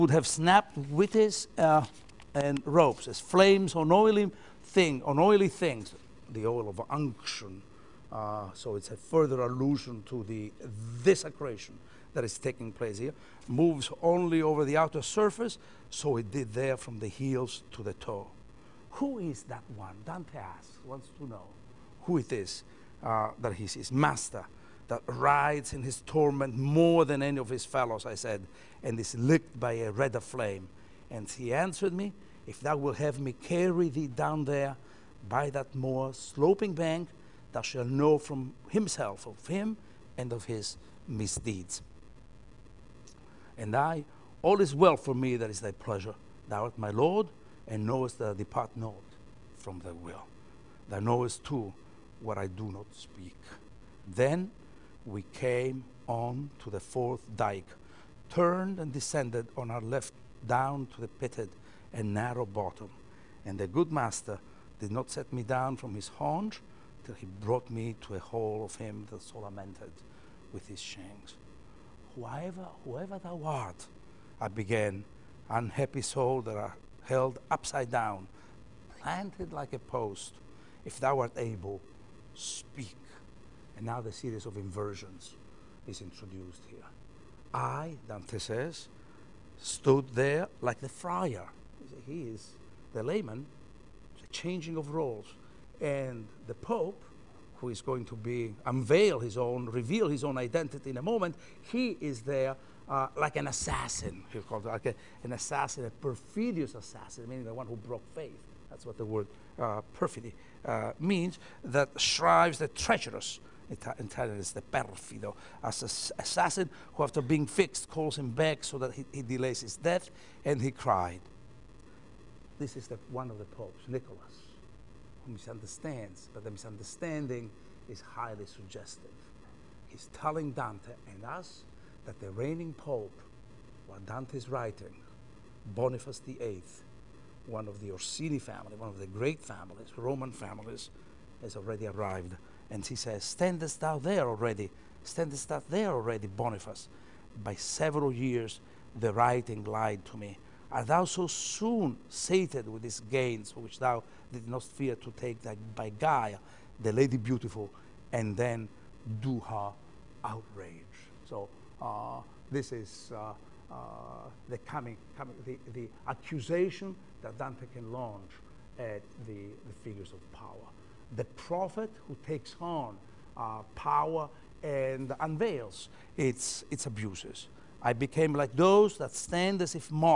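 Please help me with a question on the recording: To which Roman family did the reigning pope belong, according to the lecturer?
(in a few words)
Orsini.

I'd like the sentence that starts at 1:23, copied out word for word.
And now the series of inversions is introduced here.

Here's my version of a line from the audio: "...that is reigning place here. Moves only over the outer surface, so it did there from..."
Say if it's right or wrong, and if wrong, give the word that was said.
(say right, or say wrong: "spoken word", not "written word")
wrong: "taking", not "reigning".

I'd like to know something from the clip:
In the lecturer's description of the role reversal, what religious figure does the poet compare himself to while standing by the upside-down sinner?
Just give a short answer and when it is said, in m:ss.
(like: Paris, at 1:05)
the friar, at 1:30.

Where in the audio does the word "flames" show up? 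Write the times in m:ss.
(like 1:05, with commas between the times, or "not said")
0:03, 0:30.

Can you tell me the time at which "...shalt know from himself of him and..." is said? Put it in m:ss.
0:37.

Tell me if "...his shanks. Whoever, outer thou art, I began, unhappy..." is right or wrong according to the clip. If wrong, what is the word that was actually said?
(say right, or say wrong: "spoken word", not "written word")
wrong: "whoever", not "outer".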